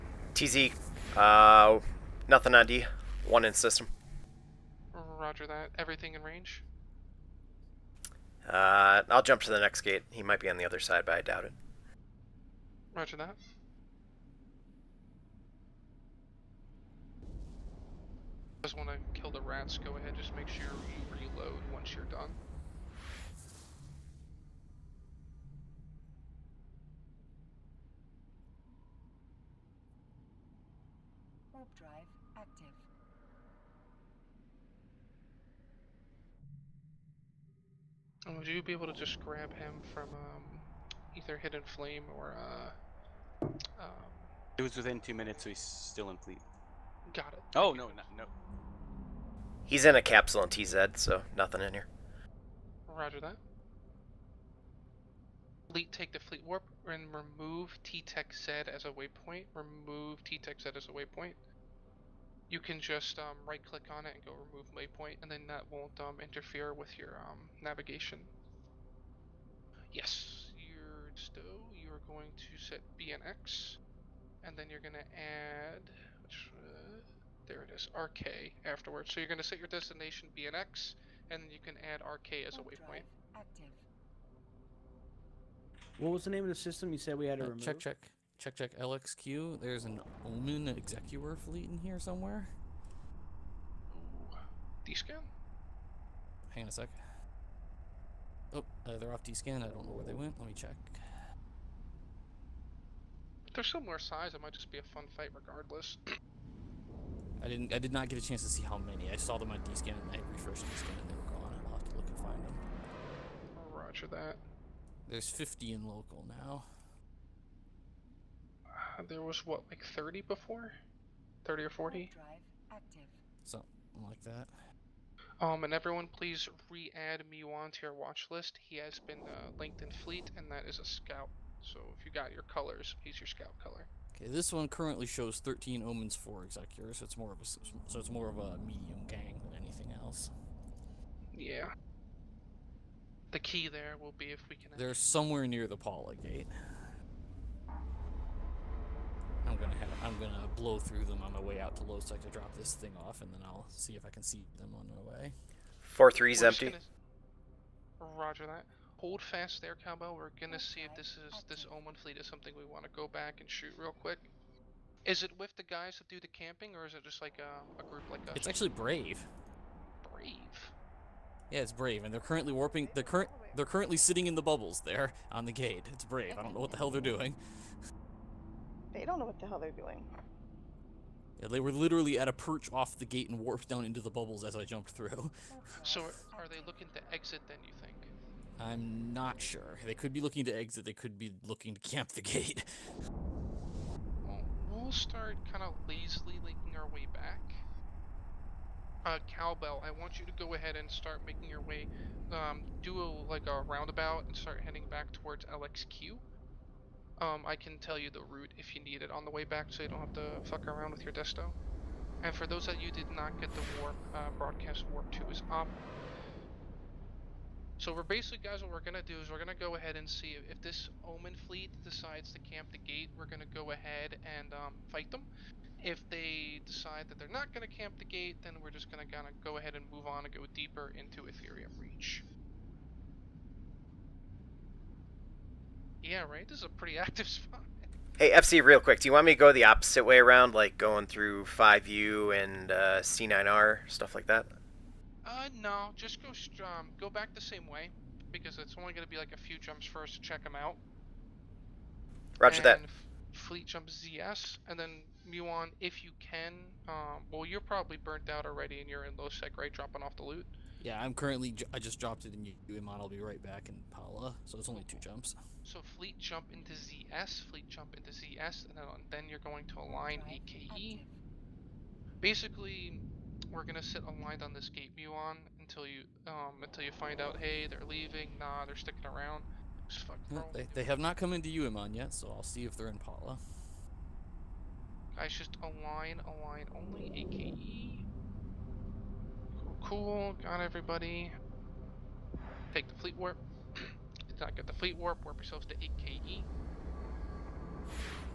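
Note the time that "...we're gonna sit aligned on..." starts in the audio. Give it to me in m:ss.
4:33.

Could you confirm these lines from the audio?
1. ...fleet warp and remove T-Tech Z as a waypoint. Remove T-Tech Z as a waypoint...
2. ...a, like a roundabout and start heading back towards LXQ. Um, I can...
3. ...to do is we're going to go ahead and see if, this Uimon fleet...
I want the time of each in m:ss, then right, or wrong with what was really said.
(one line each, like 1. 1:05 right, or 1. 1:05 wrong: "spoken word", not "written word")
1. 0:56 right
2. 3:23 right
3. 3:39 wrong: "Omen", not "Uimon".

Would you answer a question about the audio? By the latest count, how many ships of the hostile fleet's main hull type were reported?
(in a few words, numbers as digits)
13.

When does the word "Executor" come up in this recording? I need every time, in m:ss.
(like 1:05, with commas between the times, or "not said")
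1:30, 2:16.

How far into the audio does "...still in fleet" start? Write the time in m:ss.
0:45.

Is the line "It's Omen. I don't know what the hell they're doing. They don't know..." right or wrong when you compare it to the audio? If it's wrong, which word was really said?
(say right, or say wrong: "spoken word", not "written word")
wrong: "Brave", not "Omen".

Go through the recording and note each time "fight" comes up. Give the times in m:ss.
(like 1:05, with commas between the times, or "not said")
1:45, 3:44.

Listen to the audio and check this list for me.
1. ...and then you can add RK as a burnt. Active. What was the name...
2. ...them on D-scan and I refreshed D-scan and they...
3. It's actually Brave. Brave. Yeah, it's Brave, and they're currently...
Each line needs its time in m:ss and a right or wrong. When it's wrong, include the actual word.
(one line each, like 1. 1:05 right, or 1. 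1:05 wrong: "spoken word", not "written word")
1. 1:21 wrong: "waypoint", not "burnt"
2. 1:49 right
3. 2:48 right.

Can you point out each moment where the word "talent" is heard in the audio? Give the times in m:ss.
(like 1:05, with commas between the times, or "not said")
not said.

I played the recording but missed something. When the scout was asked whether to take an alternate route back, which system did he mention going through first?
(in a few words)
5U.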